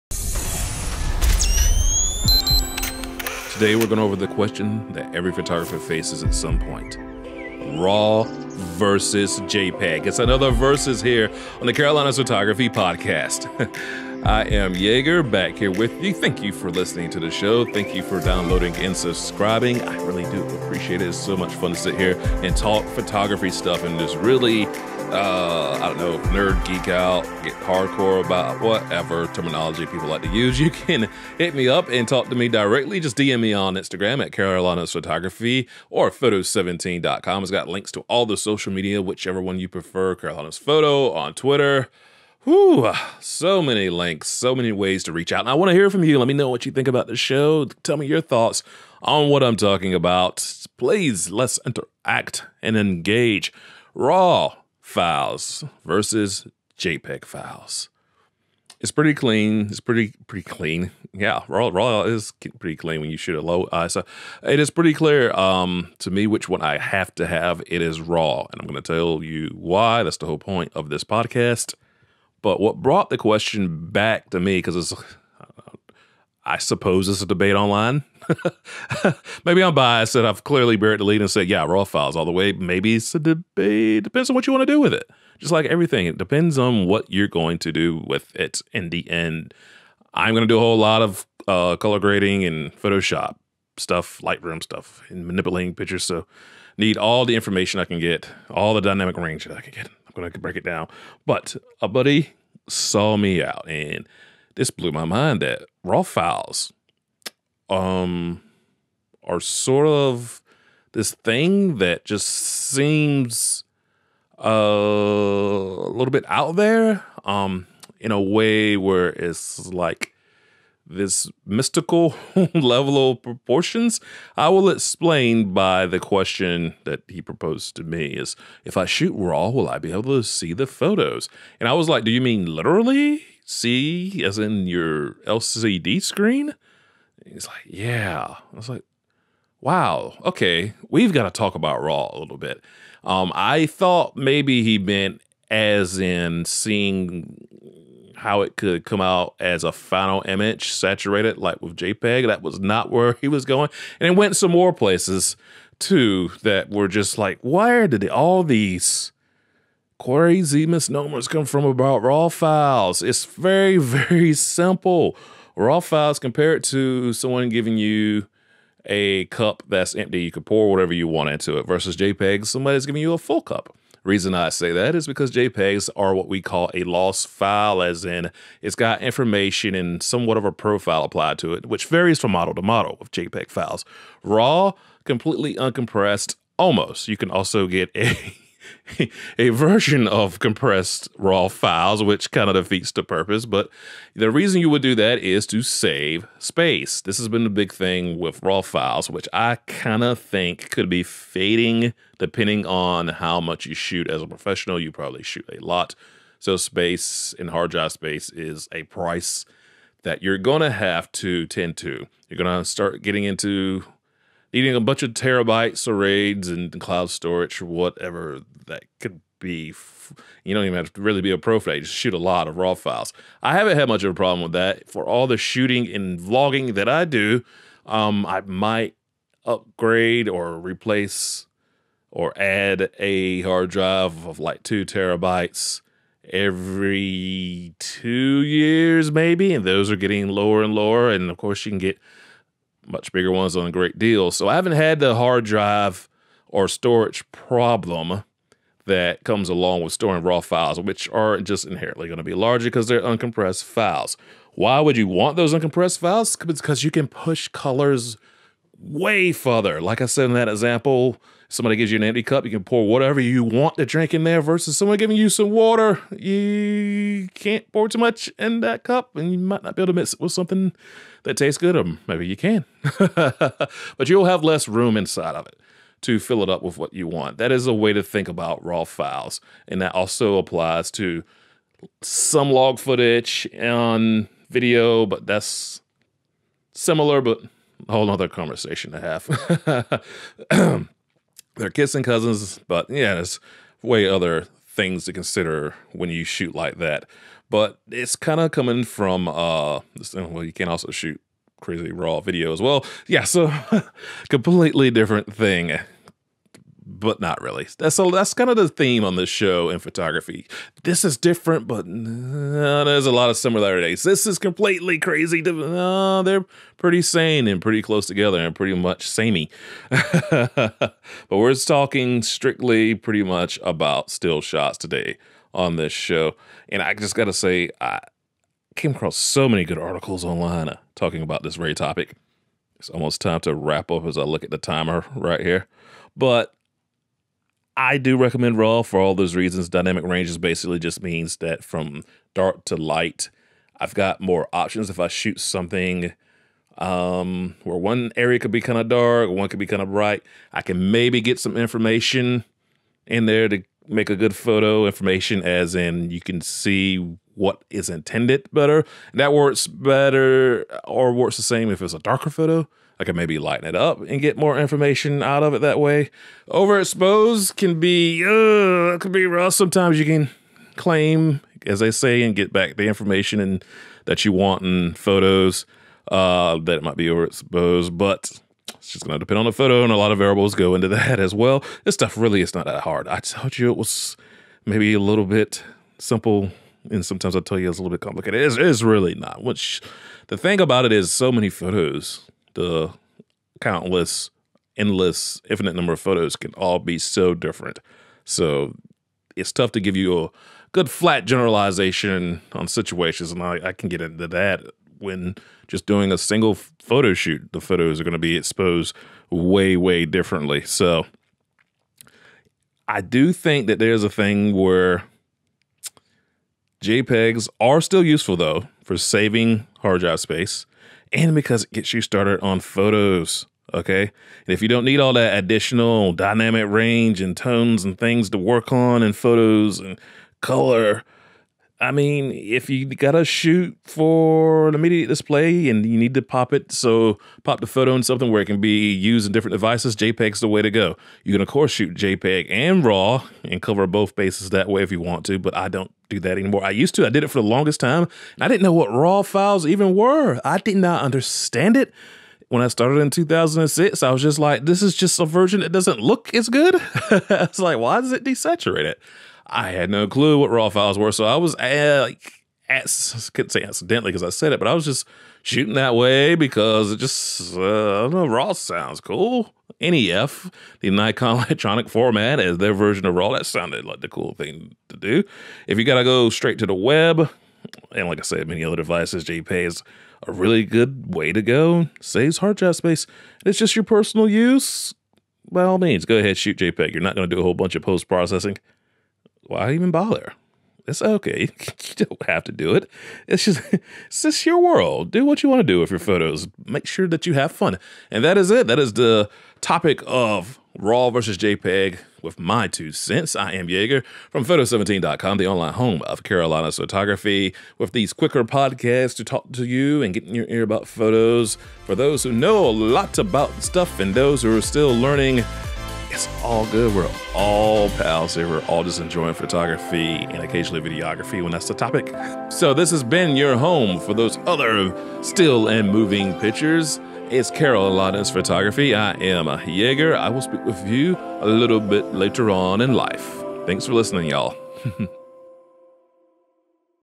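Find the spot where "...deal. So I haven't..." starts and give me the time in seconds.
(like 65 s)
243 s.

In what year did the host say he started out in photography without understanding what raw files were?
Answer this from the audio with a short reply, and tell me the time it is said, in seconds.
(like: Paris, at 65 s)
2006, at 453 s.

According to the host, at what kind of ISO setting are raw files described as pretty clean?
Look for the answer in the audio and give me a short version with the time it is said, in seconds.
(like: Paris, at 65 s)
Low ISO, at 63 s.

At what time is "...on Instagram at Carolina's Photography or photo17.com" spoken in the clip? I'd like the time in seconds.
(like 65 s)
33 s.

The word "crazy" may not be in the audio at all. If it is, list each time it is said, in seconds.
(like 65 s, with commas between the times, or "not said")
160 s, 301 s, 314 s.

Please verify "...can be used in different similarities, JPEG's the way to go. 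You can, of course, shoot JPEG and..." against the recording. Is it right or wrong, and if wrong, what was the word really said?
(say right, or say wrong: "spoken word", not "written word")
wrong: "devices", not "similarities".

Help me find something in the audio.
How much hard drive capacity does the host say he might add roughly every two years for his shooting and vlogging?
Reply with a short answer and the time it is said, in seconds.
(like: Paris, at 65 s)
2 terabytes, at 234 s.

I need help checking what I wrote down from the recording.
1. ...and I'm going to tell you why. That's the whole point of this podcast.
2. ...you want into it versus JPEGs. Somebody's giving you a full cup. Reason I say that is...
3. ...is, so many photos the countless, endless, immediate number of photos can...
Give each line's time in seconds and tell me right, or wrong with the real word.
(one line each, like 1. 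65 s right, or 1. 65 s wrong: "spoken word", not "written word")
1. 68 s right
2. 170 s right
3. 390 s wrong: "infinite", not "immediate".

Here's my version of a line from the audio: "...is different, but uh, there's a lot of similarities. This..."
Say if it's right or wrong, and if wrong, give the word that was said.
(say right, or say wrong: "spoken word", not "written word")
right.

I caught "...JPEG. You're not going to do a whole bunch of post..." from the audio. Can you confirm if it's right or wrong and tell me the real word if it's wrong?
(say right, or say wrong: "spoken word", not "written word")
right.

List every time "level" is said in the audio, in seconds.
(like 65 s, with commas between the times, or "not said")
122 s.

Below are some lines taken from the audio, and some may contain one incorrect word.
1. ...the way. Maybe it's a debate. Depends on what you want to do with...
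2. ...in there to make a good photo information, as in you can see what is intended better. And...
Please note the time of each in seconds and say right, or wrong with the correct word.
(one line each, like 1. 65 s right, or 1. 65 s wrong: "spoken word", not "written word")
1. 82 s right
2. 353 s right.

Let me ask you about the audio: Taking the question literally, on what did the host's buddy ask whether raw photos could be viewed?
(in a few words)
LCD screen.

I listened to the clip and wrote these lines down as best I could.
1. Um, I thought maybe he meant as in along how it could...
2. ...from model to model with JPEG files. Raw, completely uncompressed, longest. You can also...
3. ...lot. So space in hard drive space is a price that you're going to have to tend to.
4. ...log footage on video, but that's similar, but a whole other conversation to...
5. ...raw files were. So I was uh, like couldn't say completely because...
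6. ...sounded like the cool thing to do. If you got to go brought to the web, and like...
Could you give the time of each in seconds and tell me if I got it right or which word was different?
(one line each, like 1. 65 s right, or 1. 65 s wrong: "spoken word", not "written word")
1. 143 s wrong: "seeing", not "along"
2. 182 s wrong: "almost", not "longest"
3. 205 s right
4. 282 s right
5. 460 s wrong: "accidentally", not "completely"
6. 473 s wrong: "straight", not "brought".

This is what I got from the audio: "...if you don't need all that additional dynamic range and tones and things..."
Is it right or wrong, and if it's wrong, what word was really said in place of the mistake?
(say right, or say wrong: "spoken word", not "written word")
right.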